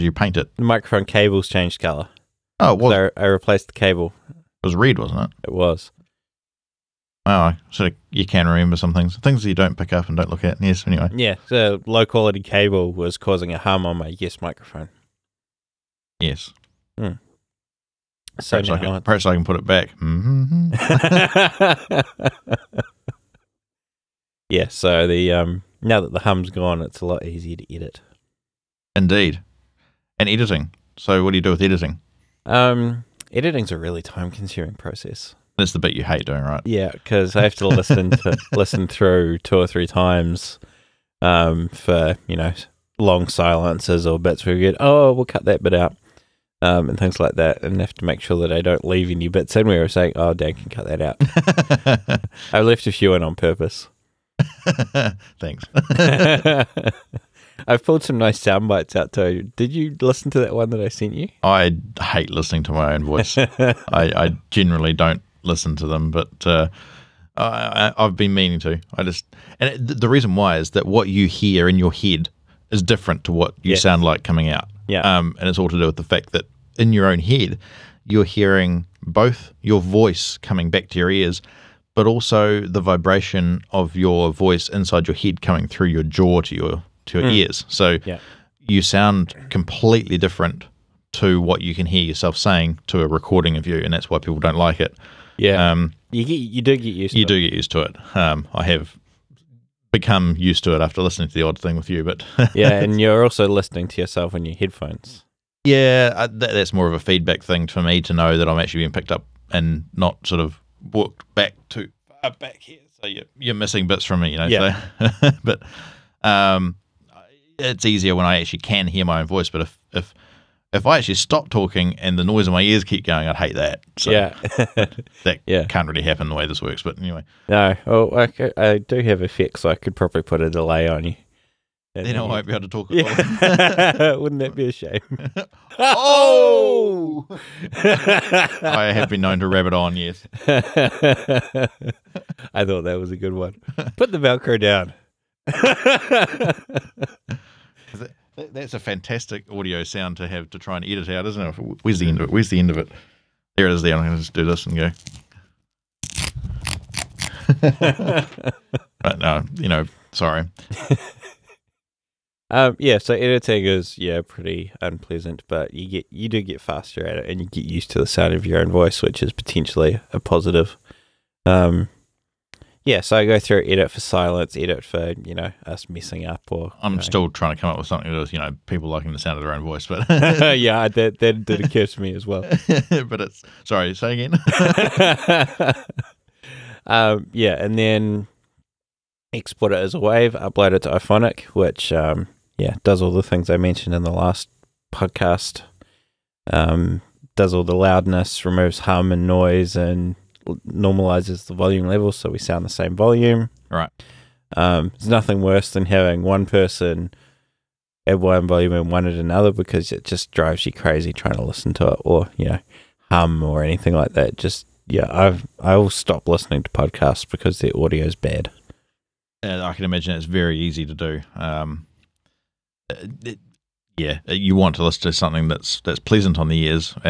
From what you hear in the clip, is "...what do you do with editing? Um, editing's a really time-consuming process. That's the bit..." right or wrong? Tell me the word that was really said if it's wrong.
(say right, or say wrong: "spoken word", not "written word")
right.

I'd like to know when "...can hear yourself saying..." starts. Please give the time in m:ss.
1:31.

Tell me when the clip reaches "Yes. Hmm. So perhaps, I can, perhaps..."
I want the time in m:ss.
0:16.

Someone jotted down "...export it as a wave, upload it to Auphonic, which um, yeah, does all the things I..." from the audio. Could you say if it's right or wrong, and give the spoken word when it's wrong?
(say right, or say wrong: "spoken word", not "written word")
right.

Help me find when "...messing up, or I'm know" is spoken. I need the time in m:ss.
2:55.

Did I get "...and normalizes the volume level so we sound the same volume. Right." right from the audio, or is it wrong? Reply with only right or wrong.
right.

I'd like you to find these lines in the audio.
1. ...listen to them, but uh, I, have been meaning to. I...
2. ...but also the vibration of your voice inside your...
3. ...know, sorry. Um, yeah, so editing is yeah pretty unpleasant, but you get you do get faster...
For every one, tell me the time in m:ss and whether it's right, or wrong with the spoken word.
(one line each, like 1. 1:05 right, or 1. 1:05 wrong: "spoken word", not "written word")
1. 1:05 right
2. 1:21 right
3. 2:39 right.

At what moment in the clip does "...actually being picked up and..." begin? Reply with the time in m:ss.
1:48.